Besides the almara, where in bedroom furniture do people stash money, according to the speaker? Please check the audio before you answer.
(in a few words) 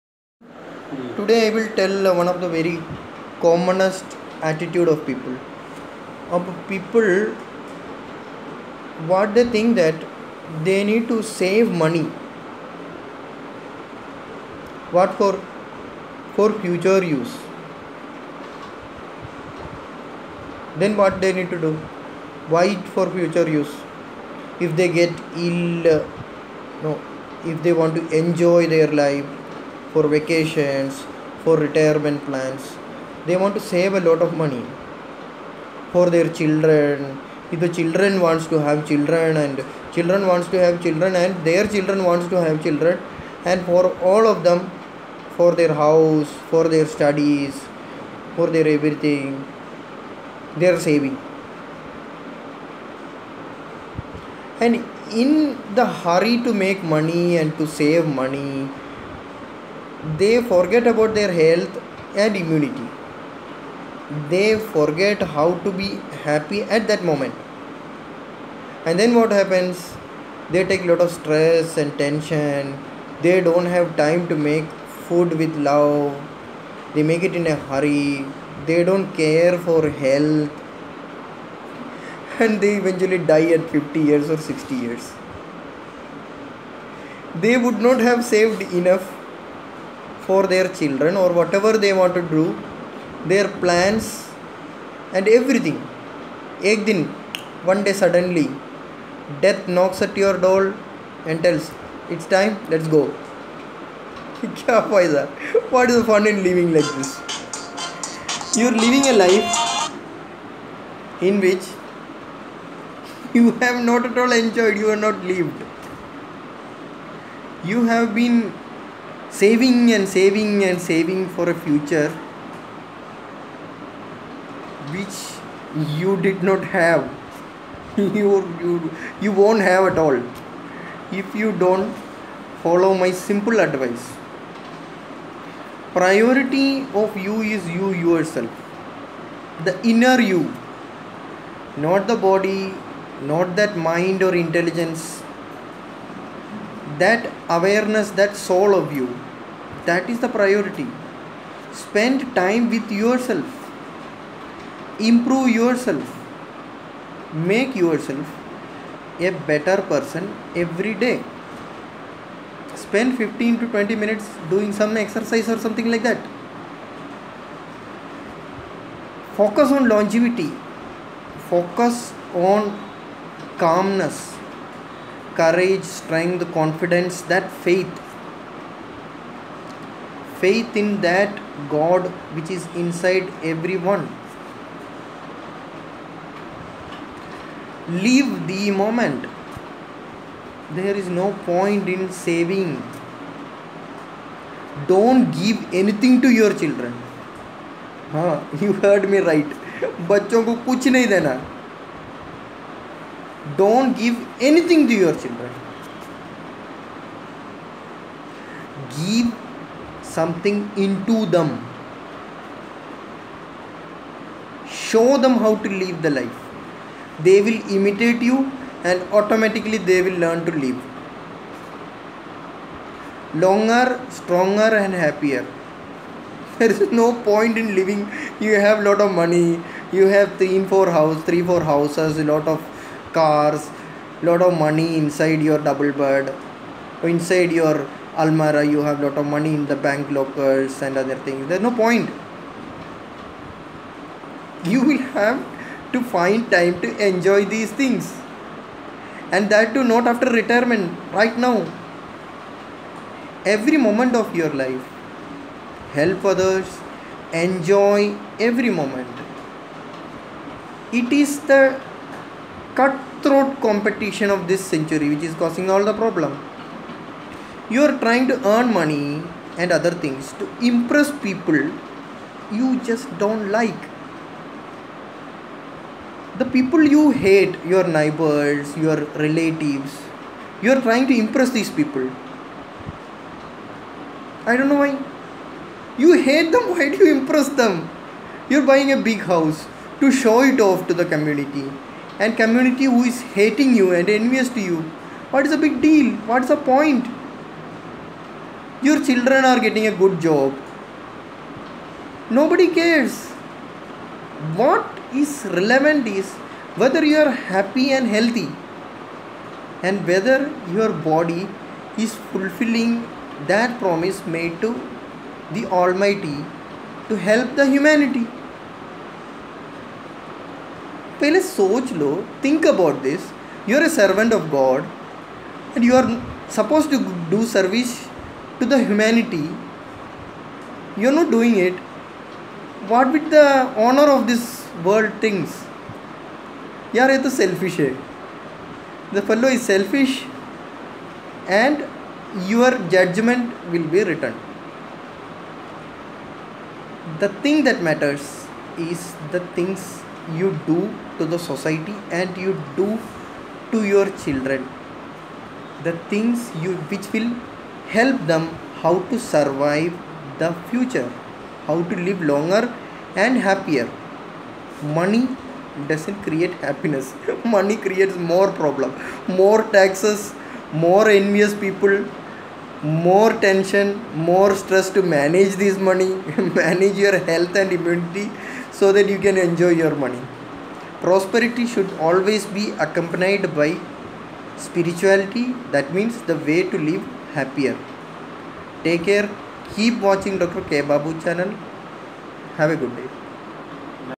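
Double bed.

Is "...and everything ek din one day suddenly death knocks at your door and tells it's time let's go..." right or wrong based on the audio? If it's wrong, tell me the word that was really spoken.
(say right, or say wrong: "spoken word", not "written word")
right.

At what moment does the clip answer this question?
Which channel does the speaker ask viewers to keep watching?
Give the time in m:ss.
6:30.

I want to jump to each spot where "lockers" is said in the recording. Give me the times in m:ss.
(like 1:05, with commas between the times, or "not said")
4:00.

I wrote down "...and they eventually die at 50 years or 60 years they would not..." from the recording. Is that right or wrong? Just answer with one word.
right.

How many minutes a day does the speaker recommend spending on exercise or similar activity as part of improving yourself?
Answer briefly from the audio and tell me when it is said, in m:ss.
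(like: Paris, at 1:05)
15 to 20, at 2:43.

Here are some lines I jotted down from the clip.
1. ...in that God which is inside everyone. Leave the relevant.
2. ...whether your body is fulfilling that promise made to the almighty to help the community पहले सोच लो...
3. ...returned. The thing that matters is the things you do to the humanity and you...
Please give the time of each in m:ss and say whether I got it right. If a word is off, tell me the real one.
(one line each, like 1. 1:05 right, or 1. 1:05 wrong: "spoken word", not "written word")
1. 3:00 wrong: "moment", not "relevant"
2. 5:10 wrong: "humanity", not "community"
3. 5:44 wrong: "society", not "humanity".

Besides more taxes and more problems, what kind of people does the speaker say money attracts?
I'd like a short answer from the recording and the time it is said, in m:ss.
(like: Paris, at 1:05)
Envious people, at 6:10.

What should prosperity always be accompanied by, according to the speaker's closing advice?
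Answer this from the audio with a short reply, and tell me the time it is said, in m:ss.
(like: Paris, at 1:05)
Spirituality, at 6:24.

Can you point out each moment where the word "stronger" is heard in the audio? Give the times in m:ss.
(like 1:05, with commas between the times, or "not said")
3:44.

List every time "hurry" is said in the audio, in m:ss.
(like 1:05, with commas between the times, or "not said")
0:56, 1:17.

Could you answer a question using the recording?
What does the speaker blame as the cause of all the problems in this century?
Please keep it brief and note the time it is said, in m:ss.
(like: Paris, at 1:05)
Cutthroat competition, at 4:22.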